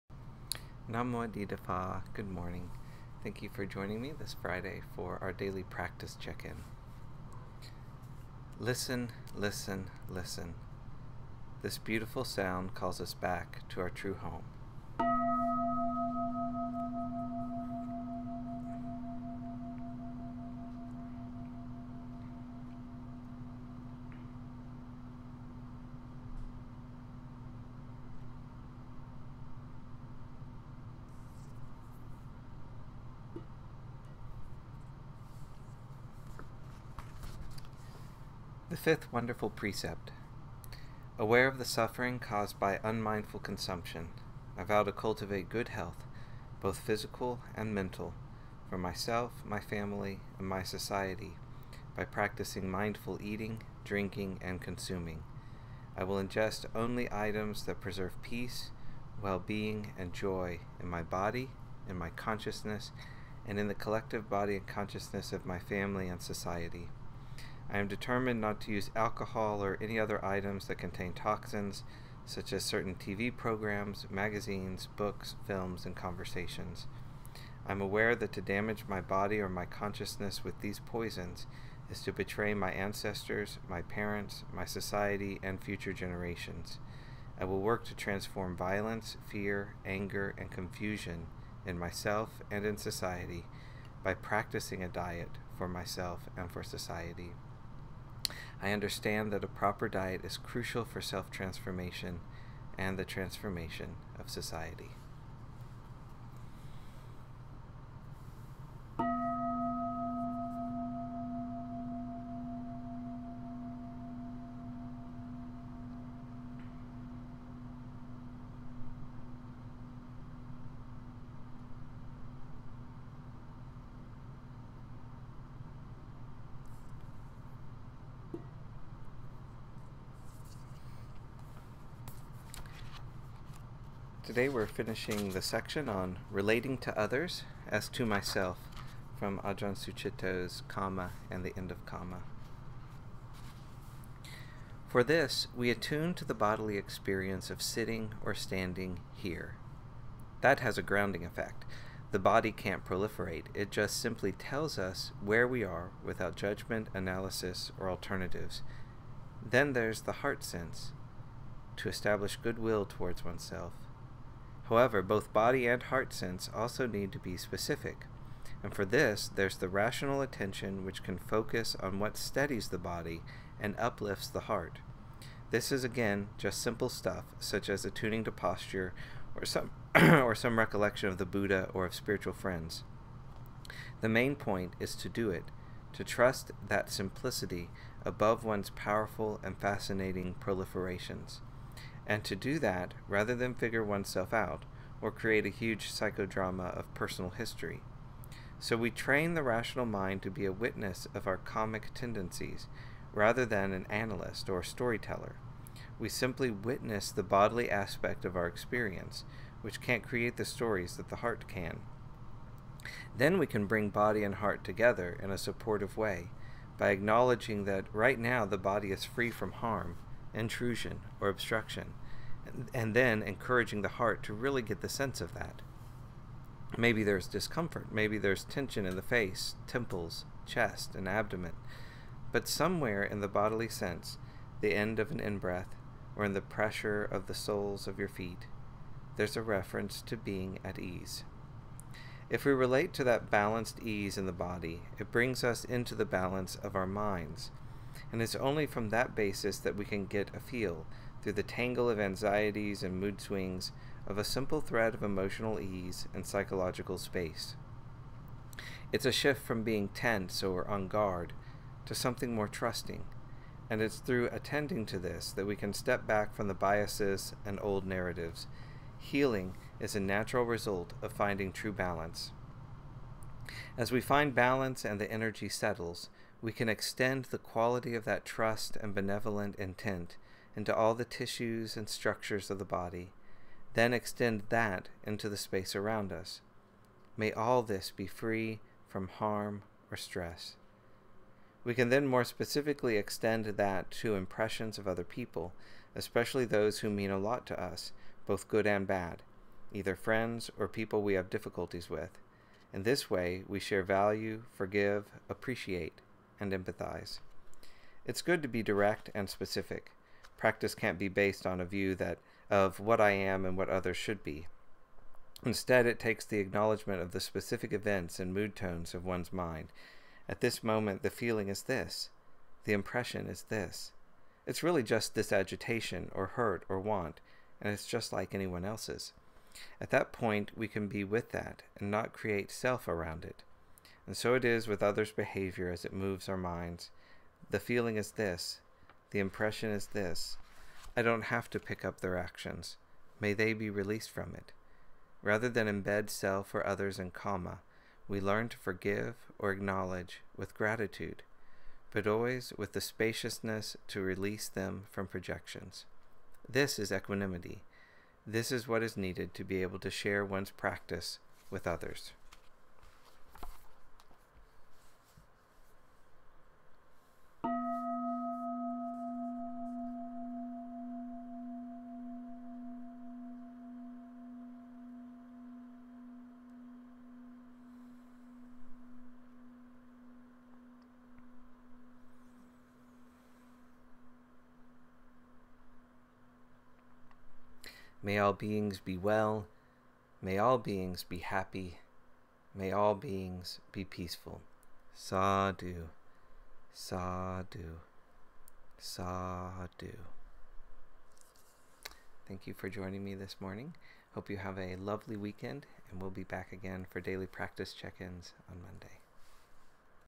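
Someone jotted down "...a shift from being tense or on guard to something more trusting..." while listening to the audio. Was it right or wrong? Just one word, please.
right.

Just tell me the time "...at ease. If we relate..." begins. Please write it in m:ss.
4:00.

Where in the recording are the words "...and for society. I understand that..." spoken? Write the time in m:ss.
1:36.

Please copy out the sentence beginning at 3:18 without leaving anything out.
So we train the rational mind to be a witness of our kammic tendencies, rather than an analyst or storyteller.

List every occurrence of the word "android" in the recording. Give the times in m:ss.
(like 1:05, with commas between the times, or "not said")
not said.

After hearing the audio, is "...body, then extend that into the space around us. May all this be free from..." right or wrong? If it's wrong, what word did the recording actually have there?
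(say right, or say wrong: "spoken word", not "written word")
right.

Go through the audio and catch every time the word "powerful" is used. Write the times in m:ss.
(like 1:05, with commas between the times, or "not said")
3:08.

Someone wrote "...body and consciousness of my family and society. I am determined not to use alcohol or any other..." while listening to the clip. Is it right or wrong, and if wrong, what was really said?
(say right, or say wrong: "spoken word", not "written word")
right.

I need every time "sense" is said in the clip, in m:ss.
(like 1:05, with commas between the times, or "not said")
2:40, 2:46, 3:44, 3:53.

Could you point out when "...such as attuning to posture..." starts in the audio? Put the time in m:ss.
2:57.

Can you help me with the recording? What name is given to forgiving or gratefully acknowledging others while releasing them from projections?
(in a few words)
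equanimity.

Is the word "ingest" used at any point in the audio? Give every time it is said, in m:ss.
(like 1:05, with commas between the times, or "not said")
0:56.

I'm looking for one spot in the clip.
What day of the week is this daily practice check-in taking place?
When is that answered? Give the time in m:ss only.
0:04.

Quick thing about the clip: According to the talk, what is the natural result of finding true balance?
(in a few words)
Healing.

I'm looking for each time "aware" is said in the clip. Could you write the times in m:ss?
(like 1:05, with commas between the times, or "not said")
0:41, 1:17.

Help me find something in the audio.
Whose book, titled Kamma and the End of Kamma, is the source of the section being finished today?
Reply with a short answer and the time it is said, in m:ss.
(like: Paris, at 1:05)
Ajahn Sucitto, at 2:19.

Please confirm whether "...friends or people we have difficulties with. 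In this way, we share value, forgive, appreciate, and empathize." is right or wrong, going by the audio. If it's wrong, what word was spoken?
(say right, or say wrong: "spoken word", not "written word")
right.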